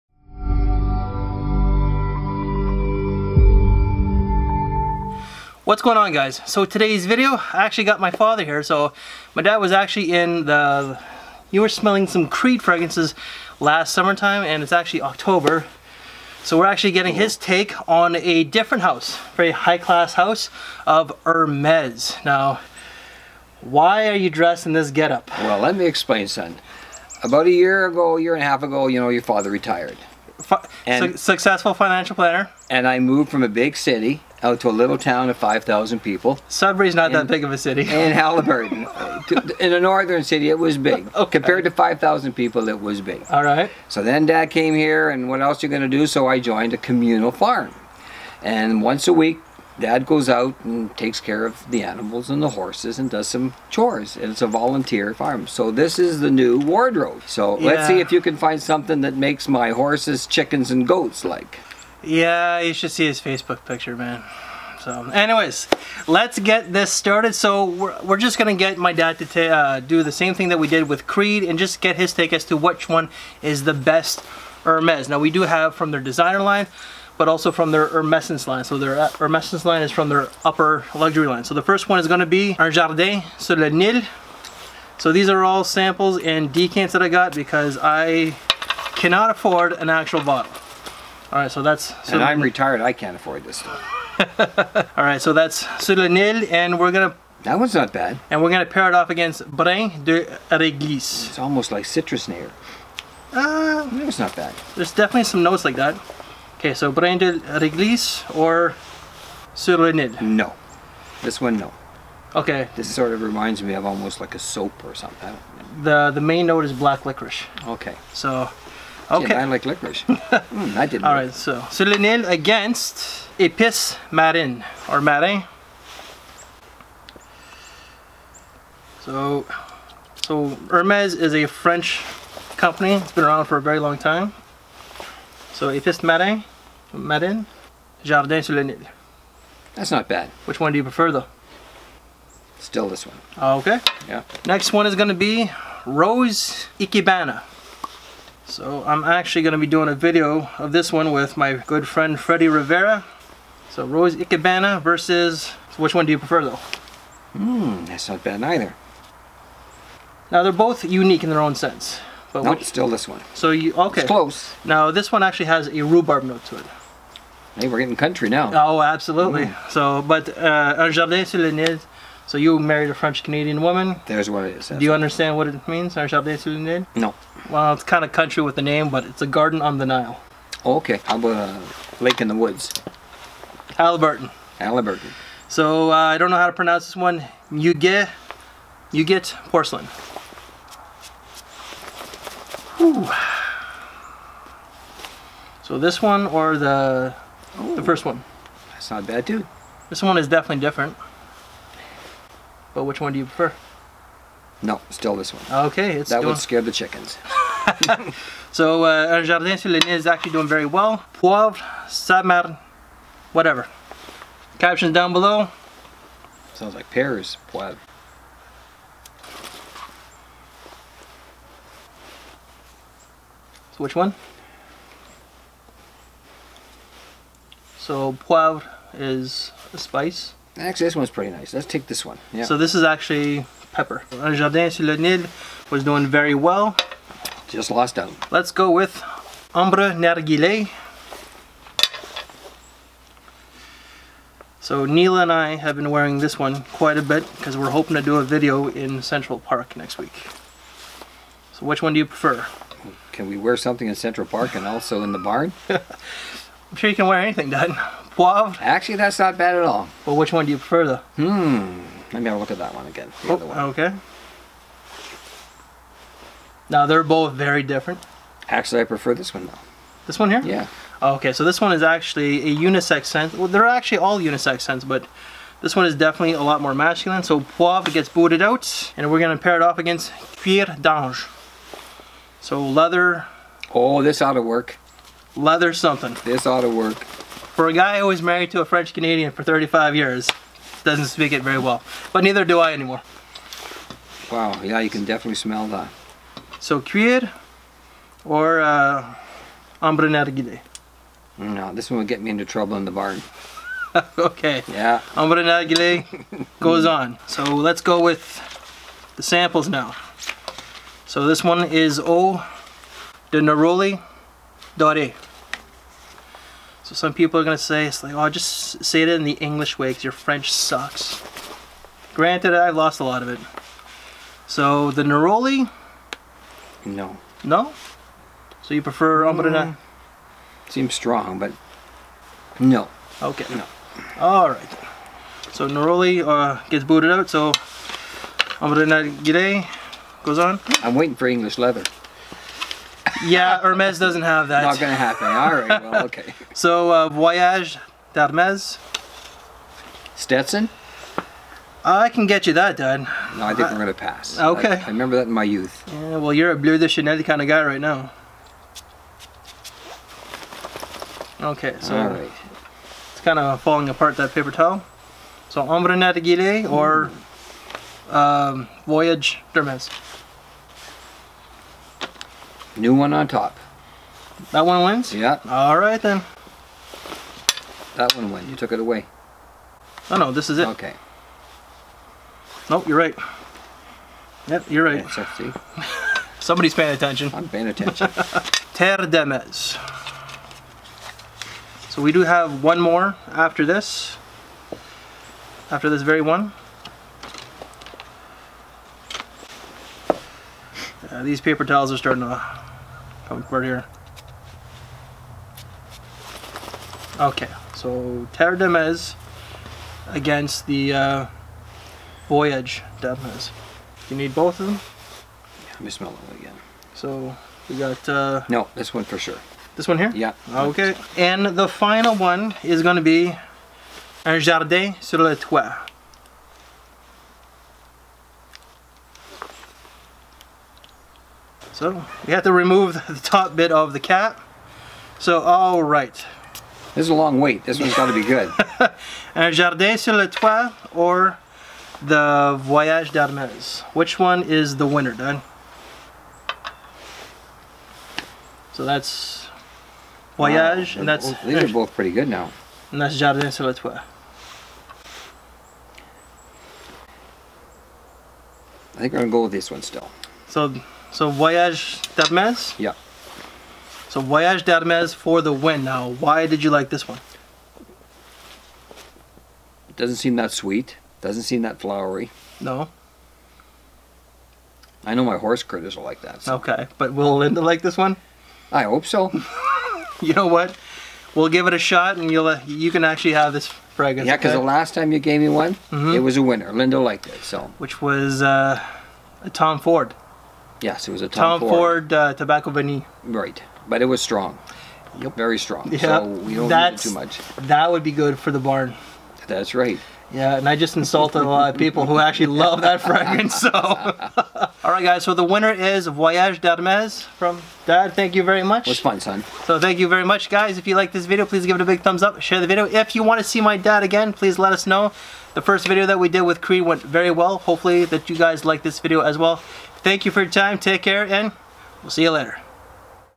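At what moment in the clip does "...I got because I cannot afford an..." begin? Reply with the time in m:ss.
1:27.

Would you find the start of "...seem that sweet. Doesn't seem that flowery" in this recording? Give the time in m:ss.
7:50.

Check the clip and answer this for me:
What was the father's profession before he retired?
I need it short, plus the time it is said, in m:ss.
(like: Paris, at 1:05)
Financial planner, at 0:31.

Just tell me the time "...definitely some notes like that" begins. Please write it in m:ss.
1:44.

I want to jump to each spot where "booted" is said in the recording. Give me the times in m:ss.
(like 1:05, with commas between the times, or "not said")
4:38, 5:36.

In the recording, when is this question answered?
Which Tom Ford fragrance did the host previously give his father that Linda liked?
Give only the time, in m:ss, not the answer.
8:12.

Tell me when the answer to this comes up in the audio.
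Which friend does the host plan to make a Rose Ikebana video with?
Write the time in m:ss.
2:32.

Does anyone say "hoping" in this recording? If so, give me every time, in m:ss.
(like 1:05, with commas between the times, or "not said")
4:07.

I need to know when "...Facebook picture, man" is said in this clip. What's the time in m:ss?
1:03.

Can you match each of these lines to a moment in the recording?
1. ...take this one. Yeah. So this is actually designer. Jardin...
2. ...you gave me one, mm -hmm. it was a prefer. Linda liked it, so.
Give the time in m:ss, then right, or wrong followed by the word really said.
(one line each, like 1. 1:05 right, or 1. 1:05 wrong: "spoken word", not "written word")
1. 3:51 wrong: "pepper", not "designer"
2. 8:05 wrong: "winner", not "prefer".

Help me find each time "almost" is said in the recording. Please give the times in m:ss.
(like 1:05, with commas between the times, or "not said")
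1:41, 1:53.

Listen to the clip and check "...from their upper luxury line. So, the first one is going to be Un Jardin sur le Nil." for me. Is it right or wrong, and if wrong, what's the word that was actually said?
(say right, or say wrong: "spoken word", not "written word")
right.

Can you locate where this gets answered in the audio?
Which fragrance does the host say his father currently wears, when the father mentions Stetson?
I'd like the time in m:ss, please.
5:56.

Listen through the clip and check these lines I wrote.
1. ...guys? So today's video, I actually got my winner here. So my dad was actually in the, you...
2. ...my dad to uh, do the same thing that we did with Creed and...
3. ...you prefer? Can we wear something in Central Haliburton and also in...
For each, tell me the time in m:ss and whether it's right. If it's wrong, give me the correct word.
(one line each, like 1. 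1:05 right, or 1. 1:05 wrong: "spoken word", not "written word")
1. 0:06 wrong: "father", not "winner"
2. 1:08 right
3. 4:11 wrong: "Park", not "Haliburton".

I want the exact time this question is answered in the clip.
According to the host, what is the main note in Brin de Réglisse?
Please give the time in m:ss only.
1:56.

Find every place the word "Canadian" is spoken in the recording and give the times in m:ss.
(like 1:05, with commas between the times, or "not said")
2:53, 4:48.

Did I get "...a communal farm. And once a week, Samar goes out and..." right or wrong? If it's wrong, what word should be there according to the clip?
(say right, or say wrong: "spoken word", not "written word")
wrong: "Dad", not "Samar".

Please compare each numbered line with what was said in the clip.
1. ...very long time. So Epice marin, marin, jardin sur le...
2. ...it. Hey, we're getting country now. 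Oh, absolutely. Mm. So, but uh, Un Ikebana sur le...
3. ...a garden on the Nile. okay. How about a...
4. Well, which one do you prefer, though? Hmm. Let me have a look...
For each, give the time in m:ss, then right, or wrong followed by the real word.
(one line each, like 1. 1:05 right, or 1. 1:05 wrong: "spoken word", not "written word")
1. 2:13 right
2. 2:46 wrong: "Jardin", not "Ikebana"
3. 2:59 right
4. 4:20 right.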